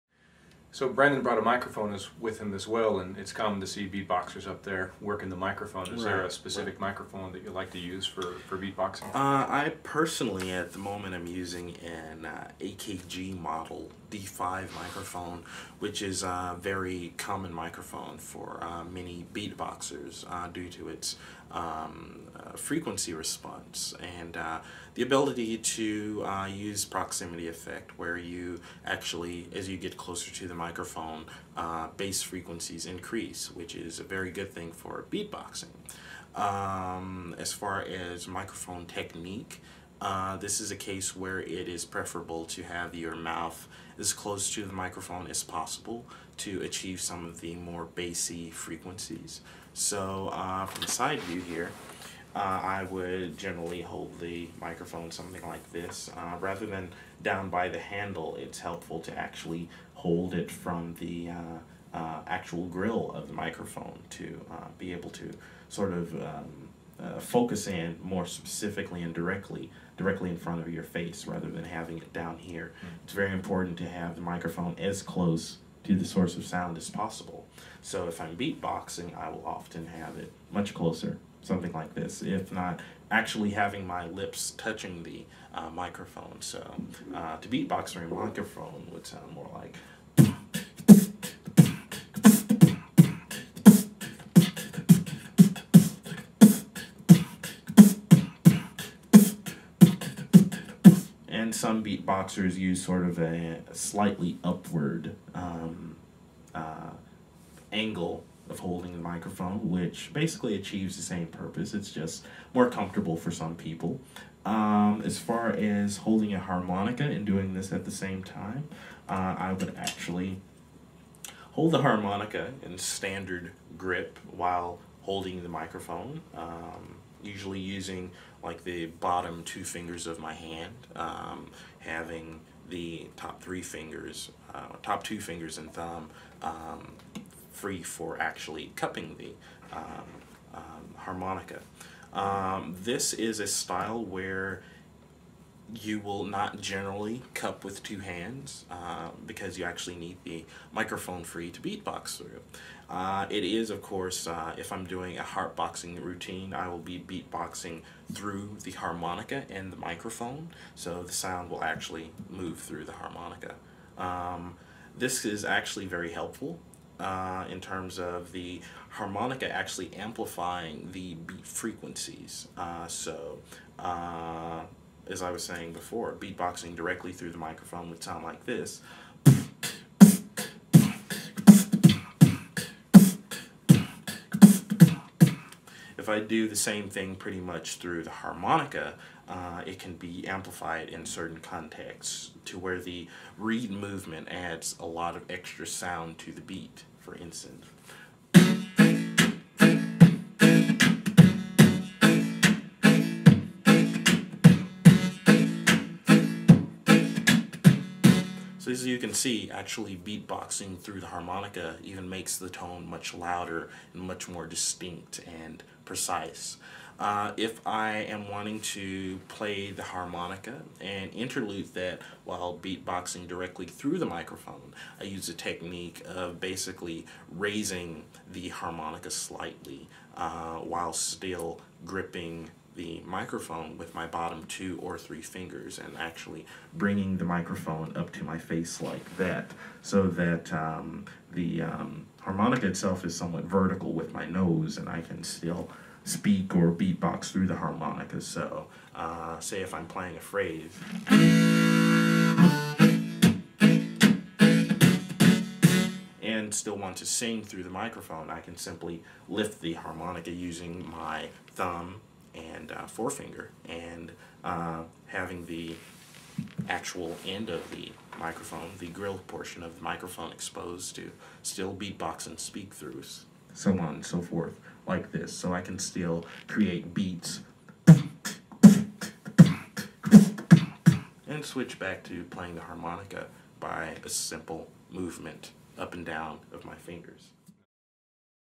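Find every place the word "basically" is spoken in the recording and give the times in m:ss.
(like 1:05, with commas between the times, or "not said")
1:50, 3:46.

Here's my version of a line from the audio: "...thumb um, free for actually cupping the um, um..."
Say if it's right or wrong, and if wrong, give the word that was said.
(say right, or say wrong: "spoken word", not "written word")
right.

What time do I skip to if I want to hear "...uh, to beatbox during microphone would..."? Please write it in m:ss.
1:27.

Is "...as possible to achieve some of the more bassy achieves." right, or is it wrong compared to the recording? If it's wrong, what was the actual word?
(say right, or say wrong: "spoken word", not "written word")
wrong: "frequencies", not "achieves".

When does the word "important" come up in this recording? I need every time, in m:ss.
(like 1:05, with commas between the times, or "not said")
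1:13.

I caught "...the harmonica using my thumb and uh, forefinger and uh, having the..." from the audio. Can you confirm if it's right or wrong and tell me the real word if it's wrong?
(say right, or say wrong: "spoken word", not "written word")
right.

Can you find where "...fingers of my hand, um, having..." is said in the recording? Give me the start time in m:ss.
2:09.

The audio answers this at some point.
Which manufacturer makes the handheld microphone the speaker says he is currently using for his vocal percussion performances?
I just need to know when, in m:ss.
0:12.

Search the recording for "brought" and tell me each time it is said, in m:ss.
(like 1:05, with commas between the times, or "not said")
0:01.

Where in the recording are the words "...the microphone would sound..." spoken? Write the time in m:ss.
2:57.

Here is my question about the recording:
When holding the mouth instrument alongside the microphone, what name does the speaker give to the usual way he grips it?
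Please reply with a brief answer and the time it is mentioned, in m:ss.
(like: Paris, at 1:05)
standard grip, at 2:02.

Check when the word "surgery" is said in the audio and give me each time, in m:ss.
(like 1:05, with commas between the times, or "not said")
not said.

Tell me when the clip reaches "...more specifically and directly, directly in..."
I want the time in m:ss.
1:08.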